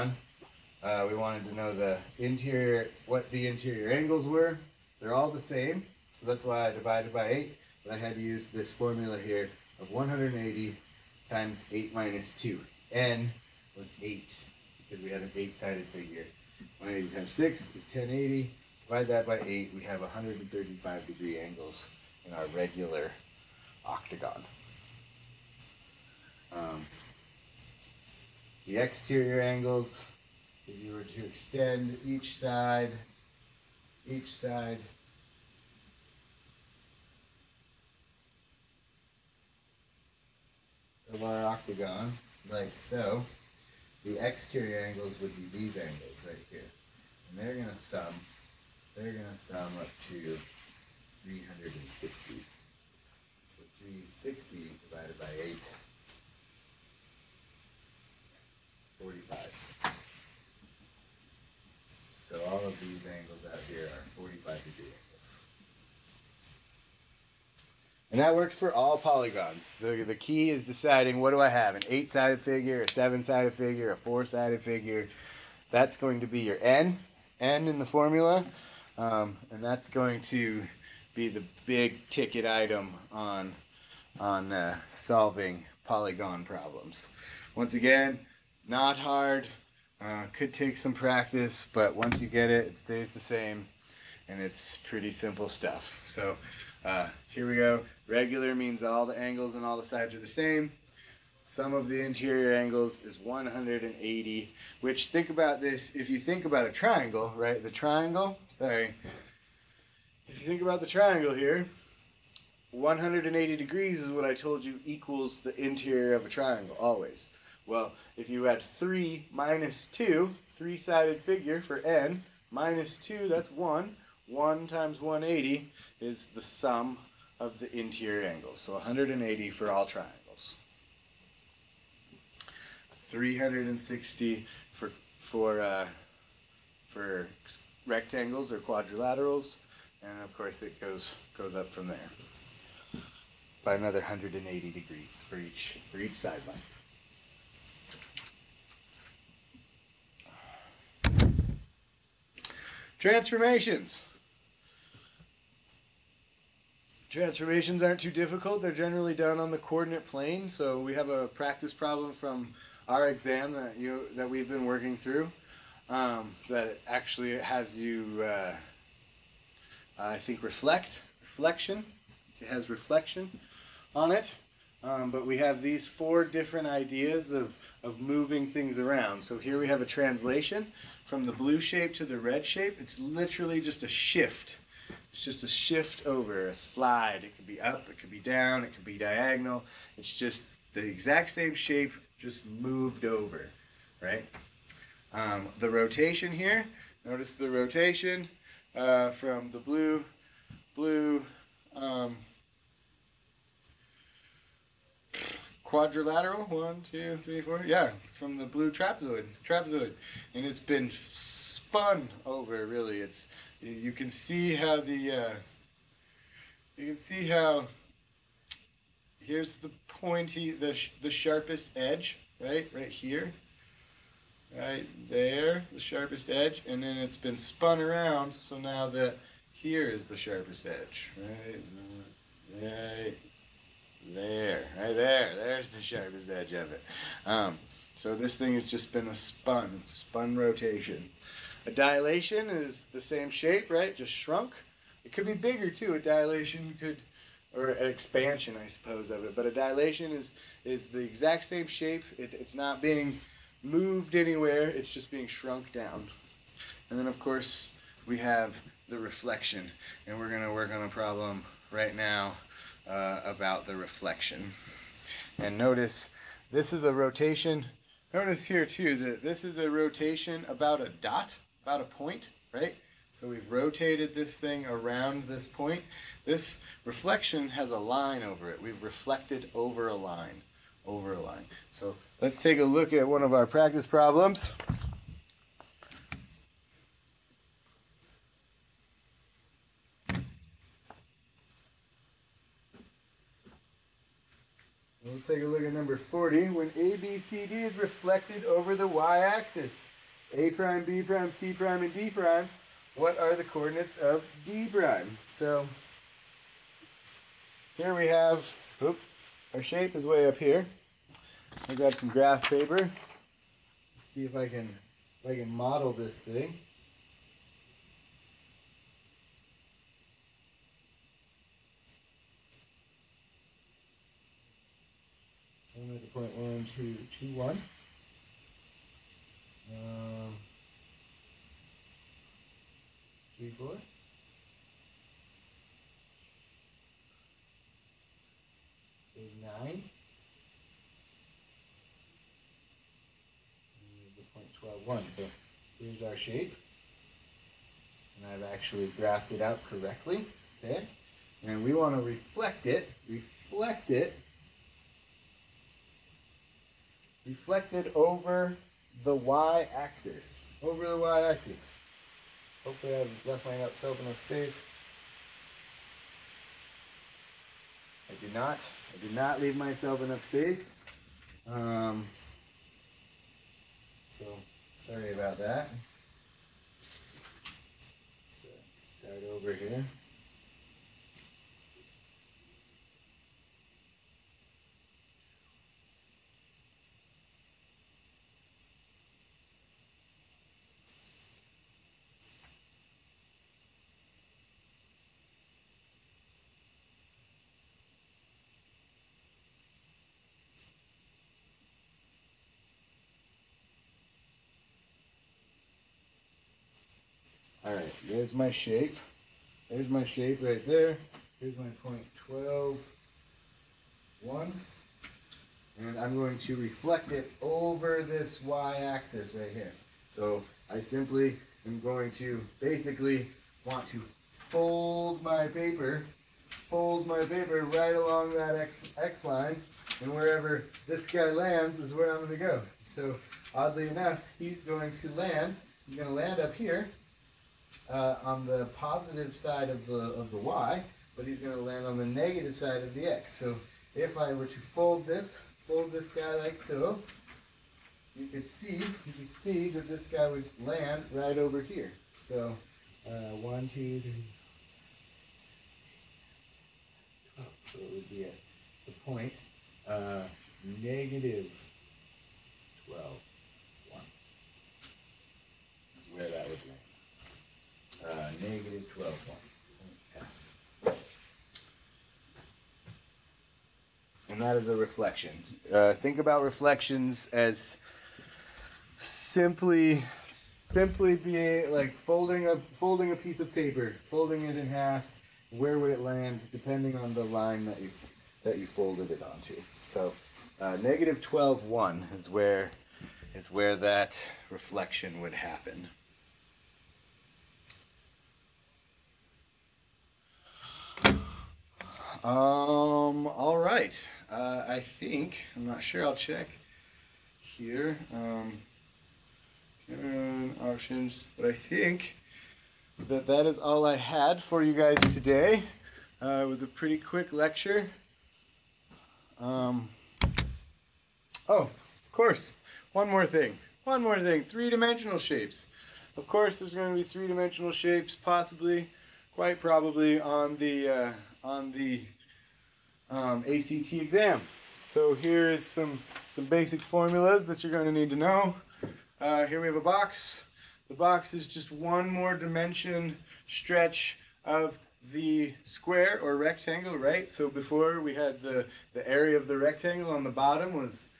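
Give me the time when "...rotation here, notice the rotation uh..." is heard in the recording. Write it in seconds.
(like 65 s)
195 s.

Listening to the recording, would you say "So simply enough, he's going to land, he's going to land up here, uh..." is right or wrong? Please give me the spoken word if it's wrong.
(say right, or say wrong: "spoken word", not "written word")
wrong: "oddly", not "simply".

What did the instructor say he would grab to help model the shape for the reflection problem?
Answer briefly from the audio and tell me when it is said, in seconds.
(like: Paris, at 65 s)
graph paper, at 312 s.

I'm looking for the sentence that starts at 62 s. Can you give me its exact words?
So all of these angles out here are 45 degree angles.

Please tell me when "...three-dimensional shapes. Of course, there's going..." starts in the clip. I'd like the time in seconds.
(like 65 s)
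524 s.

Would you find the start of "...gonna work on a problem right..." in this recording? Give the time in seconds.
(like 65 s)
260 s.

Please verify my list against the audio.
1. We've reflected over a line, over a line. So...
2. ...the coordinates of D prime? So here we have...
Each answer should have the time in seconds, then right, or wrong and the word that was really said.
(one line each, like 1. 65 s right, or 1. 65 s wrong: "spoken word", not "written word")
1. 278 s right
2. 303 s right.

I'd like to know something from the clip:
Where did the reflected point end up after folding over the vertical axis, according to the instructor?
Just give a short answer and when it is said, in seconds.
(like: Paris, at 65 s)
(-12, 1), at 460 s.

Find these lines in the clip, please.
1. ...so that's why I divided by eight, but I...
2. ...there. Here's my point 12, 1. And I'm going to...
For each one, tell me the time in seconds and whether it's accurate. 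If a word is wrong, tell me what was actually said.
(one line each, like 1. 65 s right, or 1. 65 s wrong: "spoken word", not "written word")
1. 6 s right
2. 410 s right.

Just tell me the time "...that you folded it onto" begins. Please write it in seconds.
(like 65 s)
488 s.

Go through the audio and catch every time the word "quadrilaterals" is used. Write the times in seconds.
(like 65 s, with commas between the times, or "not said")
138 s, 205 s.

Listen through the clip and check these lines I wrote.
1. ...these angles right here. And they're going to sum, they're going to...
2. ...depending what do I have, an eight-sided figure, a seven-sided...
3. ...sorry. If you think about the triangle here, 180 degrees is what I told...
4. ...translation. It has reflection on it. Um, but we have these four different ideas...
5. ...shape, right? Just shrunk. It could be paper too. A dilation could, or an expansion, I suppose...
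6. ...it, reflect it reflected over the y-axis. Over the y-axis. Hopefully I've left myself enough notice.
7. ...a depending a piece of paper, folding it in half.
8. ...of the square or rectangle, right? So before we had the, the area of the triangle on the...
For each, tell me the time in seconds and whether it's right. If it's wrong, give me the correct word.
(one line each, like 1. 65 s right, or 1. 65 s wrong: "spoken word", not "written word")
1. 45 s right
2. 70 s wrong: "deciding", not "depending"
3. 108 s right
4. 171 s wrong: "reflection", not "translation"
5. 243 s wrong: "bigger", not "paper"
6. 352 s wrong: "space", not "notice"
7. 482 s wrong: "folding", not "depending"
8. 544 s wrong: "rectangle", not "triangle".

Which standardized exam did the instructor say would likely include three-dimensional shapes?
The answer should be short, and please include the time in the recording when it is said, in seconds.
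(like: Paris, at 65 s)
ACT, at 533 s.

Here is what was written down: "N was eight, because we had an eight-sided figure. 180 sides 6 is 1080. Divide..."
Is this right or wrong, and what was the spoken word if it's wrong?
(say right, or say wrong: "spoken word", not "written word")
wrong: "times", not "sides".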